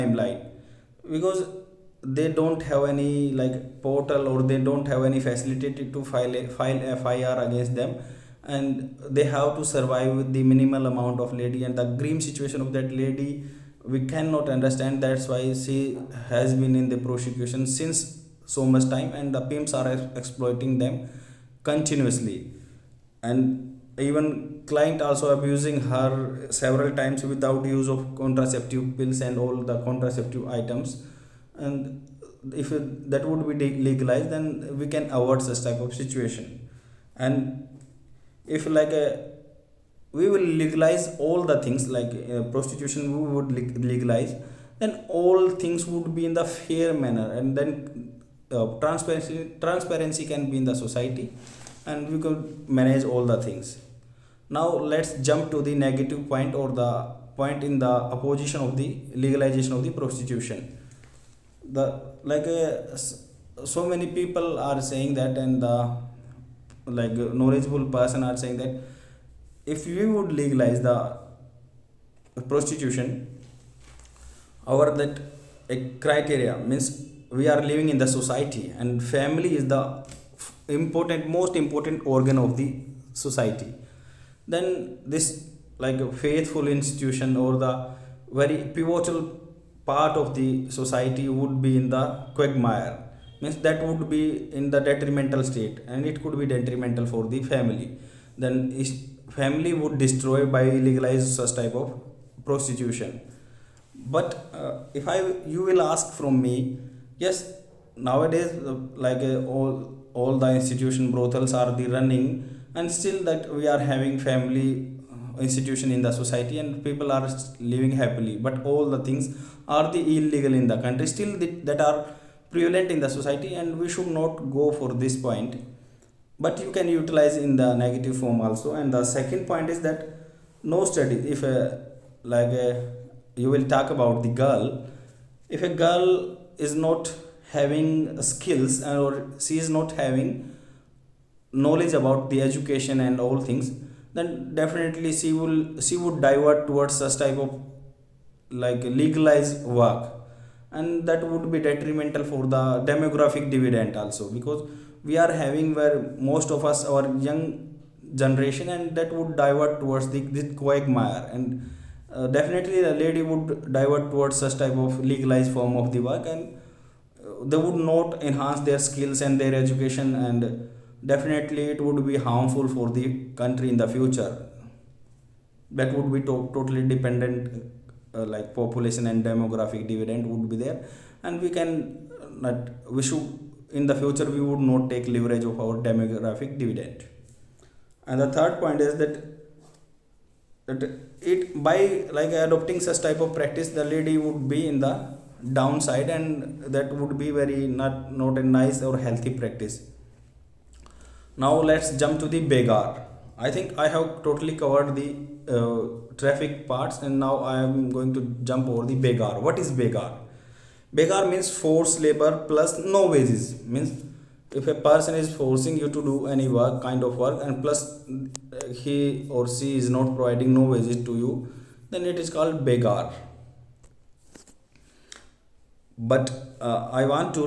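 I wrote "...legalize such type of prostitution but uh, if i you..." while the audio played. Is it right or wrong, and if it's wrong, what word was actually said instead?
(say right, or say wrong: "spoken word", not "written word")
right.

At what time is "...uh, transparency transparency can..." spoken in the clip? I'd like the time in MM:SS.
00:48.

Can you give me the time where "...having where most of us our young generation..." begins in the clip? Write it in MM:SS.
02:35.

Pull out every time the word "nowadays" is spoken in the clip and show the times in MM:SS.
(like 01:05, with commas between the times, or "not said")
01:48.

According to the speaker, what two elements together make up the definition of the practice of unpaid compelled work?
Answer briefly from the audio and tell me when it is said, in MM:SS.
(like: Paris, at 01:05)
forced labor plus no wages, at 03:31.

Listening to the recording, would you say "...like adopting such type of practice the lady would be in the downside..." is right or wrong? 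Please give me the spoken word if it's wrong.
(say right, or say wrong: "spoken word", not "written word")
right.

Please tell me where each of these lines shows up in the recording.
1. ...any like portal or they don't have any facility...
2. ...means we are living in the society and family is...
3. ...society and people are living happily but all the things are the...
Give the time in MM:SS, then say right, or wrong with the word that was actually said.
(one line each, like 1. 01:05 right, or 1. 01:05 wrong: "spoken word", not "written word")
1. 00:02 right
2. 01:16 right
3. 01:56 right.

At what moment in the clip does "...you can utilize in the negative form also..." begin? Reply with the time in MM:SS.
02:06.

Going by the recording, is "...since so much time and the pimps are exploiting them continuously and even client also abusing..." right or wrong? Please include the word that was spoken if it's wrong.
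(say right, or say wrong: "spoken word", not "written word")
right.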